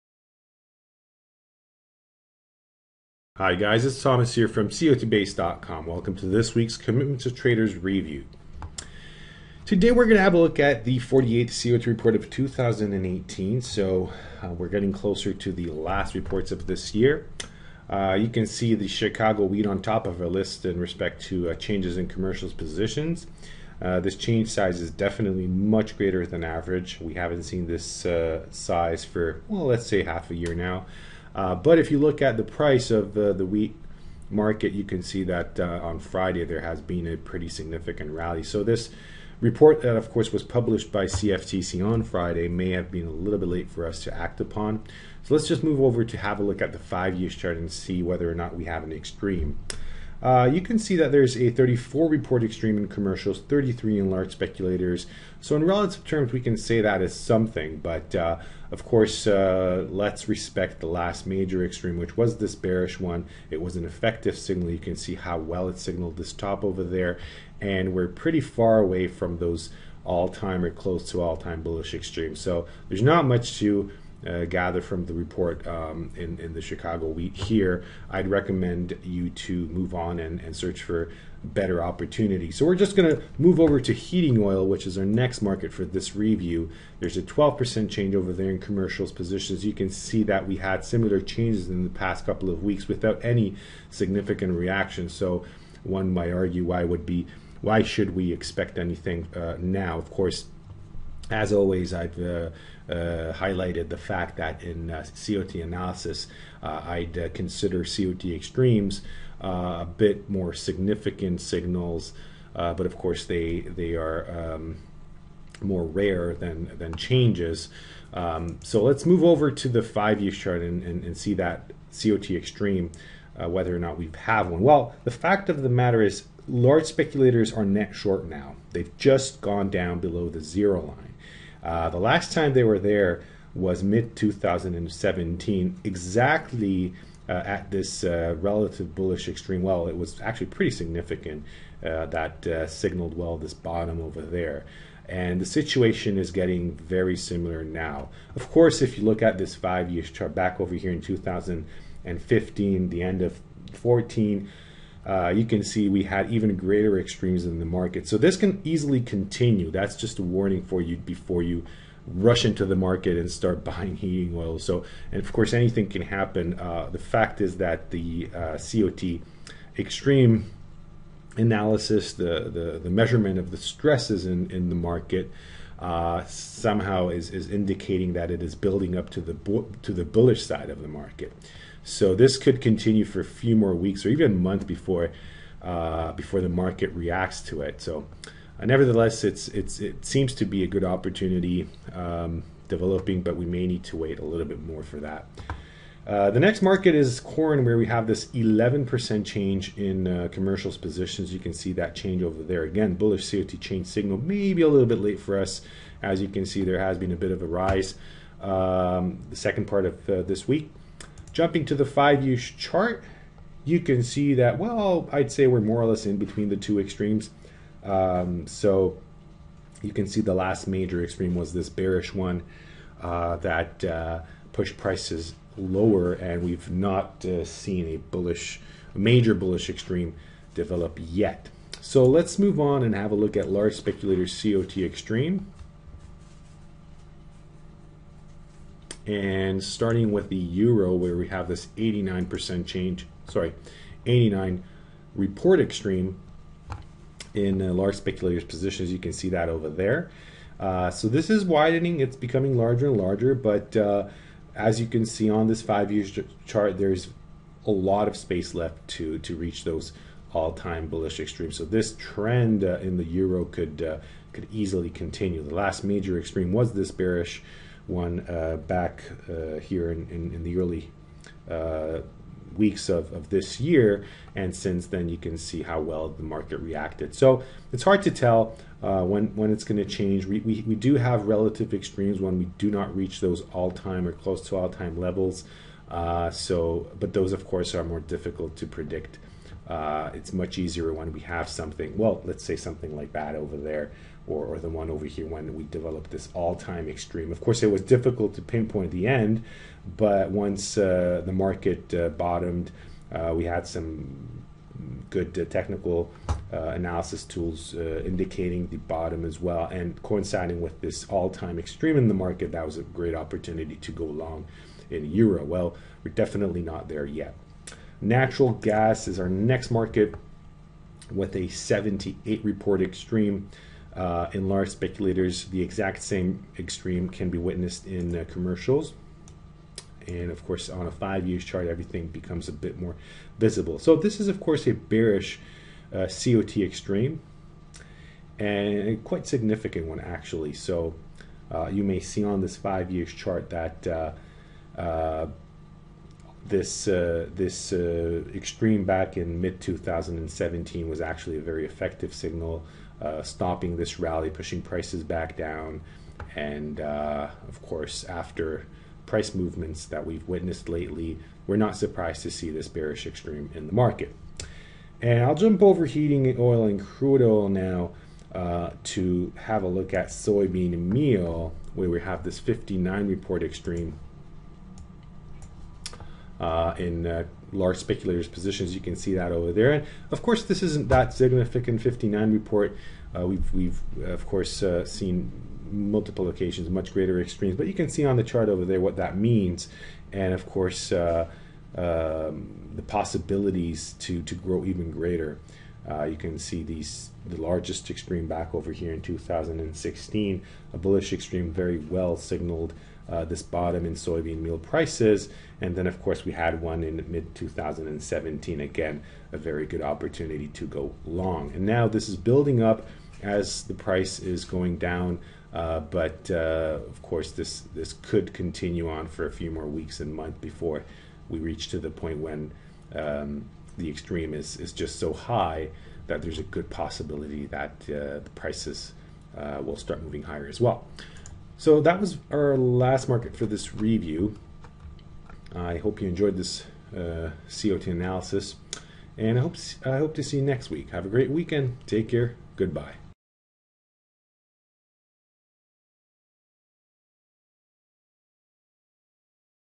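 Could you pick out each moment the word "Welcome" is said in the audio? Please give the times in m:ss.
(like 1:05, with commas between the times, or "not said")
0:05.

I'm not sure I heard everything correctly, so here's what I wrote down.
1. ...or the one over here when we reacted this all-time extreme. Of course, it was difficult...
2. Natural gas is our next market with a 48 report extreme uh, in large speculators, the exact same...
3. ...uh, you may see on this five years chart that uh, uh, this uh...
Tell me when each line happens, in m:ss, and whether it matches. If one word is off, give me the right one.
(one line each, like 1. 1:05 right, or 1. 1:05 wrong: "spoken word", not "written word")
1. 4:54 wrong: "developed", not "reacted"
2. 5:18 wrong: "78", not "48"
3. 5:41 right.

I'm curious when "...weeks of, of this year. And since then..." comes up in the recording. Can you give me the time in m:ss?
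4:32.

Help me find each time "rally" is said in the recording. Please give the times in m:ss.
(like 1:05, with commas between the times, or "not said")
0:38, 5:53.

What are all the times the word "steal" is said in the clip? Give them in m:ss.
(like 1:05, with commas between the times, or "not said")
not said.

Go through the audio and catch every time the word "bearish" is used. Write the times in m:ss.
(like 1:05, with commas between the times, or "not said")
1:02, 3:41, 4:26, 5:34, 6:02.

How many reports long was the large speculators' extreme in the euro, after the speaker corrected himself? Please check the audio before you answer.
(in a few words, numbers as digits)
89.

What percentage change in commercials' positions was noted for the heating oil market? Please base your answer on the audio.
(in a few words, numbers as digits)
12%.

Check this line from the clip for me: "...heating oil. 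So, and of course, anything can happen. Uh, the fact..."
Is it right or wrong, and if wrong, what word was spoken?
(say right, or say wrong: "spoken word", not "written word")
right.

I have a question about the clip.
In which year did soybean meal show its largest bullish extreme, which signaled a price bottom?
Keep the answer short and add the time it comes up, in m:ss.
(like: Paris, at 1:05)
2016, at 6:39.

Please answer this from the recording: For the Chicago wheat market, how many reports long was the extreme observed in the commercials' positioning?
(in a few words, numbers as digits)
34.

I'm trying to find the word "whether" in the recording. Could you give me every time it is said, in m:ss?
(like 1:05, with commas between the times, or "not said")
0:48, 2:03.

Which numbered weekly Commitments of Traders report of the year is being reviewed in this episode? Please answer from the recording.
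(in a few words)
48th.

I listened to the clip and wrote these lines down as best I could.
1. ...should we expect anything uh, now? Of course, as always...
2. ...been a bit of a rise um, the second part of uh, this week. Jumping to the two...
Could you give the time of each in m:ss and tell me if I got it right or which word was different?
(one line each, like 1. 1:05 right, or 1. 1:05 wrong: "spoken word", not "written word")
1. 1:37 right
2. 3:26 wrong: "five", not "two".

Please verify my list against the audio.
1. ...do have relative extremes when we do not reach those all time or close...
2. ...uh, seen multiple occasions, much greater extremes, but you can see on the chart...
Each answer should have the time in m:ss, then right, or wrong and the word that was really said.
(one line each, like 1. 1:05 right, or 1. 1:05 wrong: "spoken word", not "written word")
1. 4:40 right
2. 6:24 right.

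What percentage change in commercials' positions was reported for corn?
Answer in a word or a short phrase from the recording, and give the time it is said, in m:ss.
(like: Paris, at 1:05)
11%, at 3:18.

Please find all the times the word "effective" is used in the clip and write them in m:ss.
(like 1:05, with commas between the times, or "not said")
1:03, 5:51.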